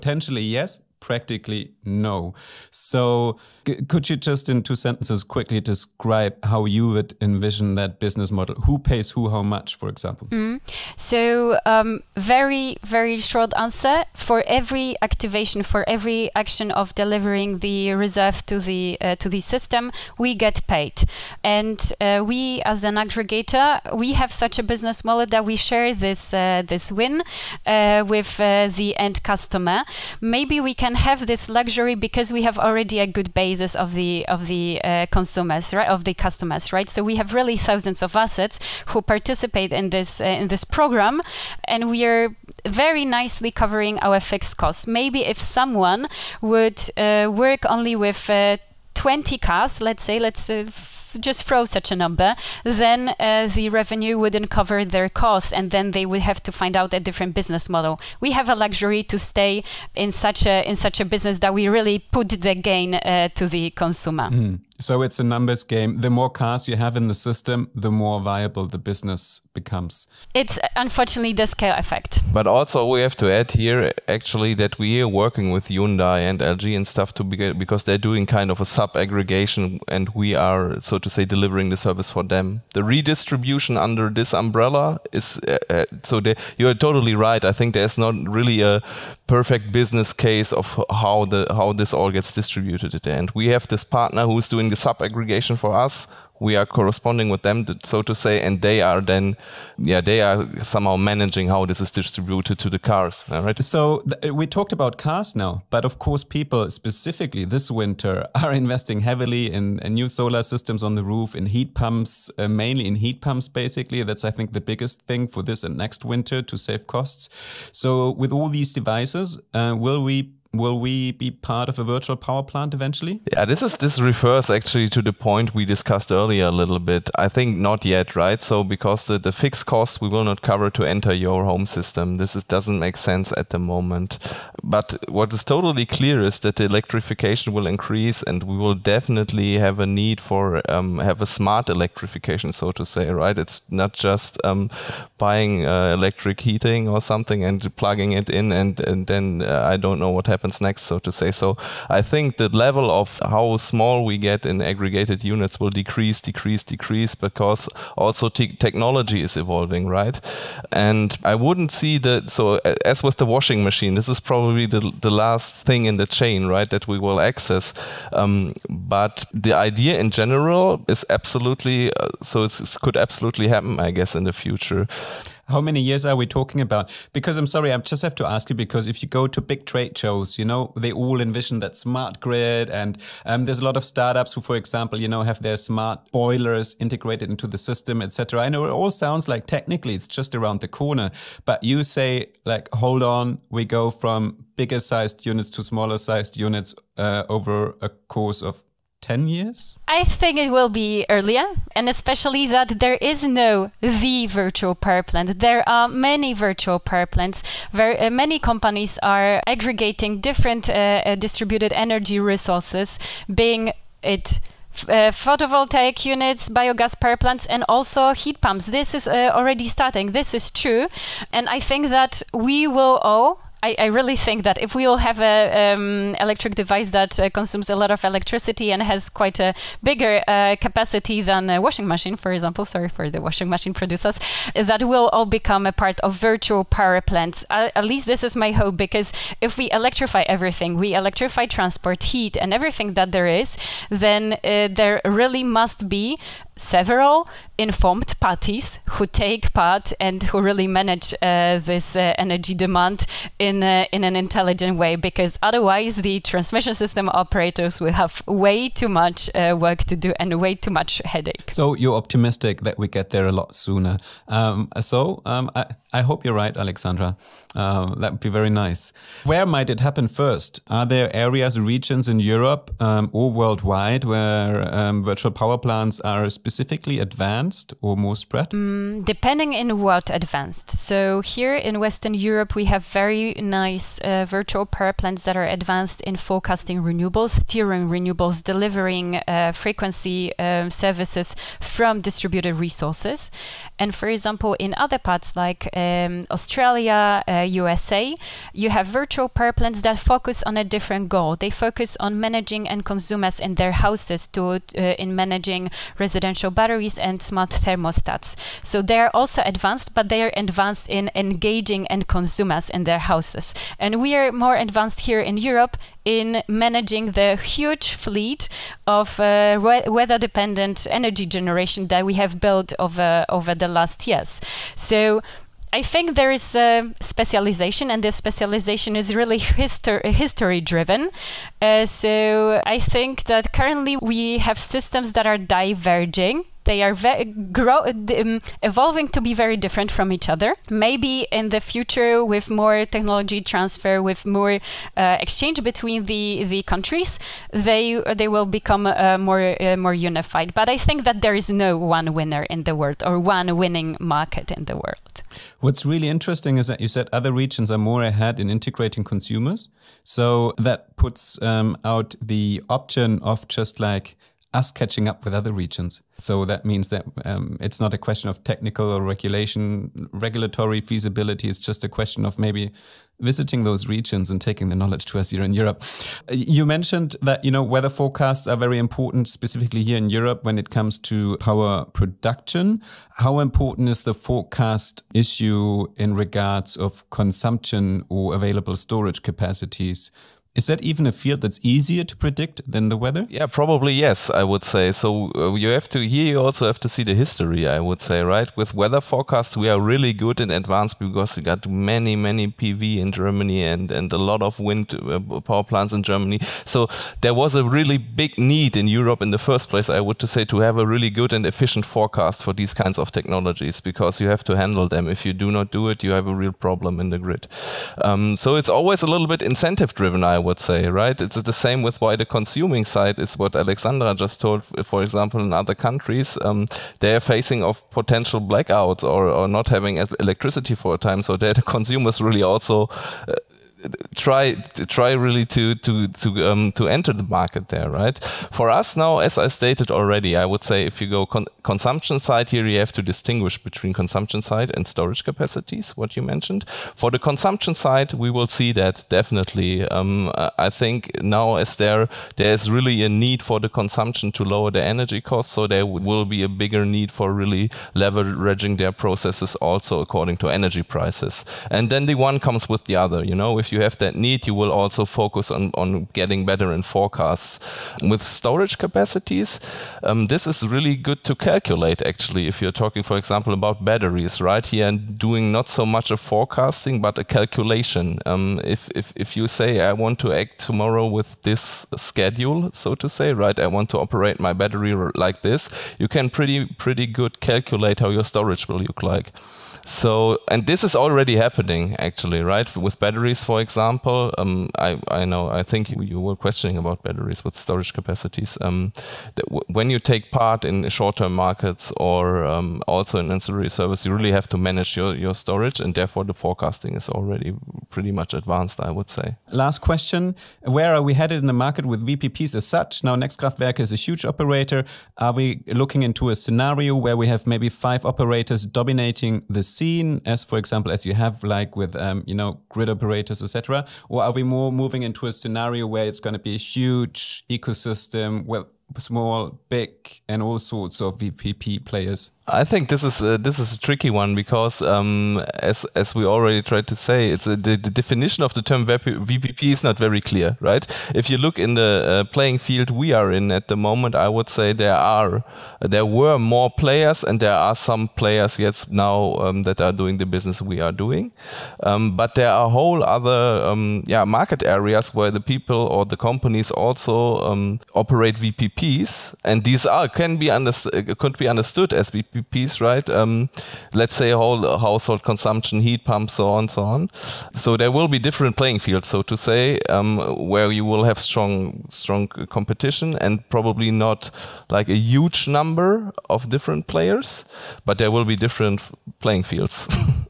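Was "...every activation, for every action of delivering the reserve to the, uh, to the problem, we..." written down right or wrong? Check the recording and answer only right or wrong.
wrong.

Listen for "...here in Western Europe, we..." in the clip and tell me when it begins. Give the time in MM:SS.
04:41.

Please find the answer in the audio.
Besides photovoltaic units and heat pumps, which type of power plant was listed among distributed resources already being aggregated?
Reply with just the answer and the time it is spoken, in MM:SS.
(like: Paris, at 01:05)
Biogas power plants, at 03:36.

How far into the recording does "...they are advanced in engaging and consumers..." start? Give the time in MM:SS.
05:10.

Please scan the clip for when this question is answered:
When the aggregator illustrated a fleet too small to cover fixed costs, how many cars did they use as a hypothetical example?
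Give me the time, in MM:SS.
00:48.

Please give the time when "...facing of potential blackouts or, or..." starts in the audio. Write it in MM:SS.
07:07.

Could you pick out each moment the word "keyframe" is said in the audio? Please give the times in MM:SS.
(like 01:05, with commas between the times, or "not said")
not said.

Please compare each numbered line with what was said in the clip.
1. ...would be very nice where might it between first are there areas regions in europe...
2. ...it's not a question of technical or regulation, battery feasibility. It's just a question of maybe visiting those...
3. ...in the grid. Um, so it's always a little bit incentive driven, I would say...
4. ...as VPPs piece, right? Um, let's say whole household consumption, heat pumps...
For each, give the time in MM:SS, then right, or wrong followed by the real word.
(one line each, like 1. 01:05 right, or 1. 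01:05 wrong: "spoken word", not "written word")
1. 04:28 wrong: "happen", not "between"
2. 06:07 wrong: "regulatory", not "battery"
3. 06:56 right
4. 09:21 right.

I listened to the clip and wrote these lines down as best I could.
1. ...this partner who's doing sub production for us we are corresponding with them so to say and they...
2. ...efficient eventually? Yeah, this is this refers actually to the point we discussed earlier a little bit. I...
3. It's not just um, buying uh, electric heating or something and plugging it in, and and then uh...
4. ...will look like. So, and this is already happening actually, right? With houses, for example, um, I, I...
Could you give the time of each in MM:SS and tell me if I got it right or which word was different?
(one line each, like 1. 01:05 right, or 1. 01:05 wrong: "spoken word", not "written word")
1. 01:33 wrong: "aggregation", not "production"
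2. 02:02 wrong: "plant", not "efficient"
3. 02:23 right
4. 08:08 wrong: "batteries", not "houses".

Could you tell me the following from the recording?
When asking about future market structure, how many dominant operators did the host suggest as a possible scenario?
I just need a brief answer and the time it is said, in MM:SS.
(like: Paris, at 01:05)
5, at 08:37.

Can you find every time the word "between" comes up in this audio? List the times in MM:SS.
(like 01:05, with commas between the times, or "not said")
05:45, 07:23.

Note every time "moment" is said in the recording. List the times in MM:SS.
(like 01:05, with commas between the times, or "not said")
02:13, 09:03.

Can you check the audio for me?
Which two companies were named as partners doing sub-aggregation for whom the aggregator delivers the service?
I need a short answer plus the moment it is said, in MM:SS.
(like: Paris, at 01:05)
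Hyundai and LG, at 01:15.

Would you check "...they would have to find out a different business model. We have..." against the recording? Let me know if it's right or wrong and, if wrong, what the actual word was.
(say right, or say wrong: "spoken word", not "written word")
right.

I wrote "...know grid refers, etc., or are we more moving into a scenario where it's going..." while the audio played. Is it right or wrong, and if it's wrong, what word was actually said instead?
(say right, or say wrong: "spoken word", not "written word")
wrong: "operators", not "refers".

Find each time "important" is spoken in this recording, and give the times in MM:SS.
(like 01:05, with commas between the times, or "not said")
06:18, 06:23.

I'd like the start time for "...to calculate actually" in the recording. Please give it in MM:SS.
07:51.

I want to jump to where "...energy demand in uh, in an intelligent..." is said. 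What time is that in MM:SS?
04:12.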